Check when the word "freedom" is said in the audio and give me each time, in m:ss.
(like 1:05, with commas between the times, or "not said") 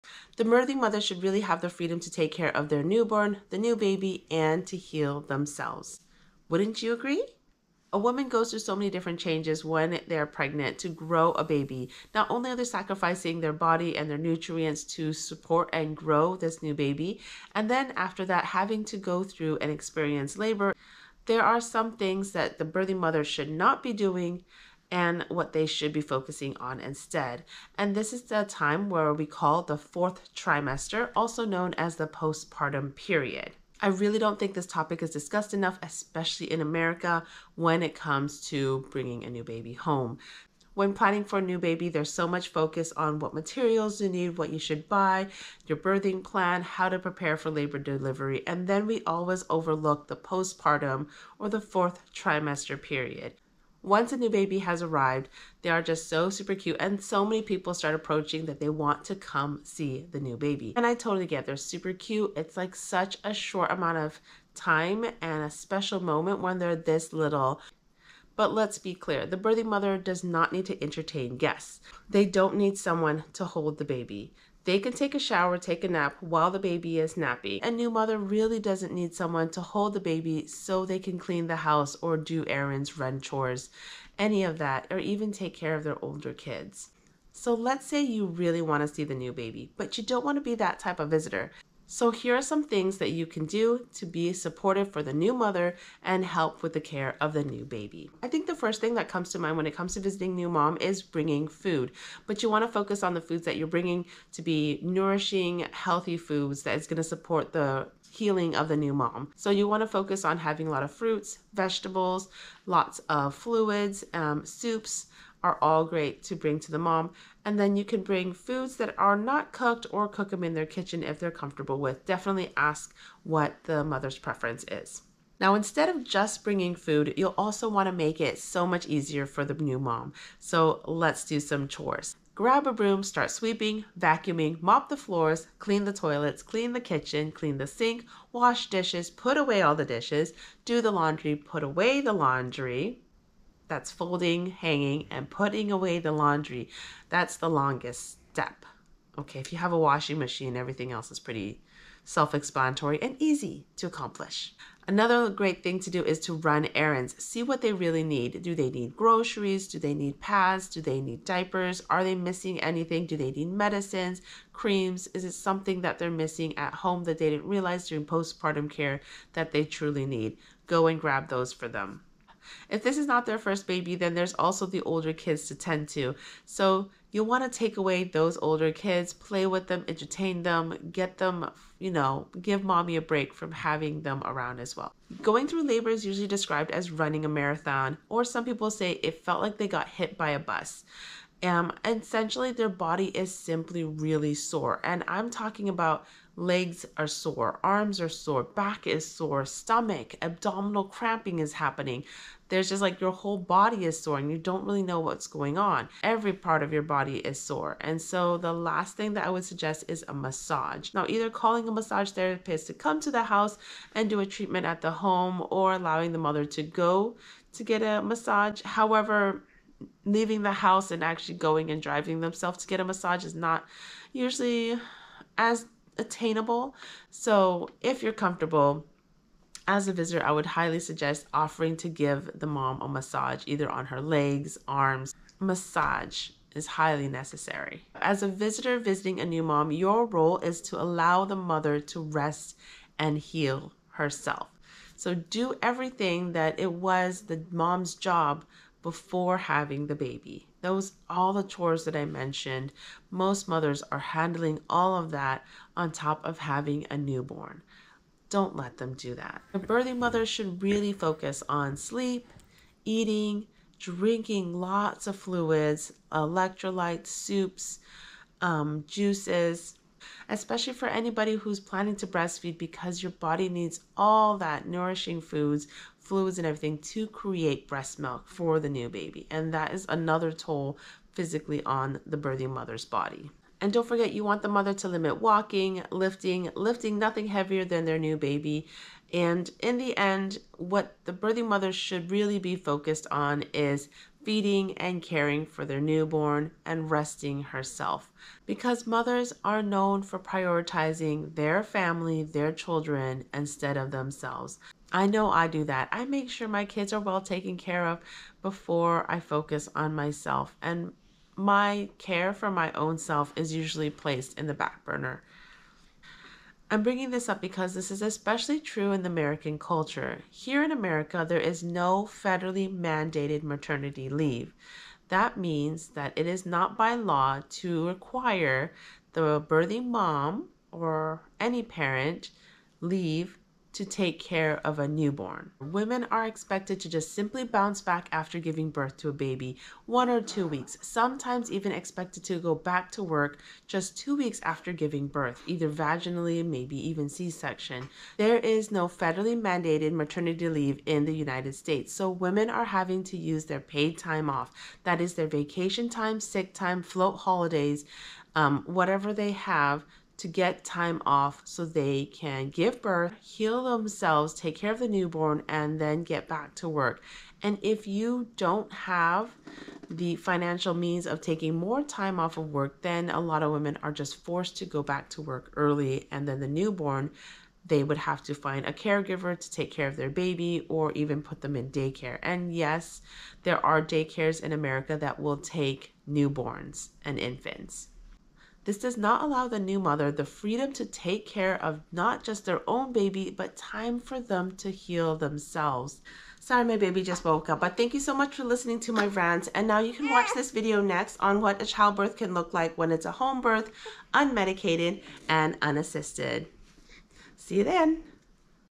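0:01, 6:30.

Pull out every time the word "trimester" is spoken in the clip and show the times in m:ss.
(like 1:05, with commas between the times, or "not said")
0:30, 0:52.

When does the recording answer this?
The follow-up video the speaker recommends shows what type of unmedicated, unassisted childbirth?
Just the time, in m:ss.
6:43.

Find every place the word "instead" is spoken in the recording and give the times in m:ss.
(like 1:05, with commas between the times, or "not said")
0:26, 2:05, 5:03.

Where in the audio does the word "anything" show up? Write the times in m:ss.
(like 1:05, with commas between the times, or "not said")
2:42.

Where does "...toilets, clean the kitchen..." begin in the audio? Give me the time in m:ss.
2:15.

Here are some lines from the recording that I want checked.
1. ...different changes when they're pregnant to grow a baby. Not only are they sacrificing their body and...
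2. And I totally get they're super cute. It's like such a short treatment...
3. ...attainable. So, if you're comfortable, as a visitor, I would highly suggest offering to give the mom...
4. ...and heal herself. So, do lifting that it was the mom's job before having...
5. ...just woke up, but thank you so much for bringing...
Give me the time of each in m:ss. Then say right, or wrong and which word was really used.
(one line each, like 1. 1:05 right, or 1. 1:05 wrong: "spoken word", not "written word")
1. 0:08 right
2. 1:00 wrong: "amount", not "treatment"
3. 3:45 right
4. 4:02 wrong: "everything", not "lifting"
5. 6:37 wrong: "listening", not "bringing".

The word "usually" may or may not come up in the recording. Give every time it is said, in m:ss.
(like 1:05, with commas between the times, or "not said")
3:06, 3:44, 5:13.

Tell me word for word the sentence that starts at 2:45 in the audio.
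Is it something that they're missing at home that they didn't realize during postpartum care that they truly need?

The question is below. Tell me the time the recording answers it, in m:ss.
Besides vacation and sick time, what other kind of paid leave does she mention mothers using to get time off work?
5:56.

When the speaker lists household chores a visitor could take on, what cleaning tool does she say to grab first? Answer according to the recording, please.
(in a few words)
Broom.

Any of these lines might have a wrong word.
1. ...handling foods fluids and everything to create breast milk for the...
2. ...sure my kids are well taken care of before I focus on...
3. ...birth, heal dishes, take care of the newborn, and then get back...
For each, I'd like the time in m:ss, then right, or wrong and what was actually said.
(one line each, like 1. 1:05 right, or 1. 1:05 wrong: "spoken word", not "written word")
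1. 4:34 wrong: "nourishing", not "handling"
2. 5:06 right
3. 6:02 wrong: "themselves", not "dishes".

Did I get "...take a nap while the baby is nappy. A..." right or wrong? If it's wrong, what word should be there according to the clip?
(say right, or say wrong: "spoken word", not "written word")
right.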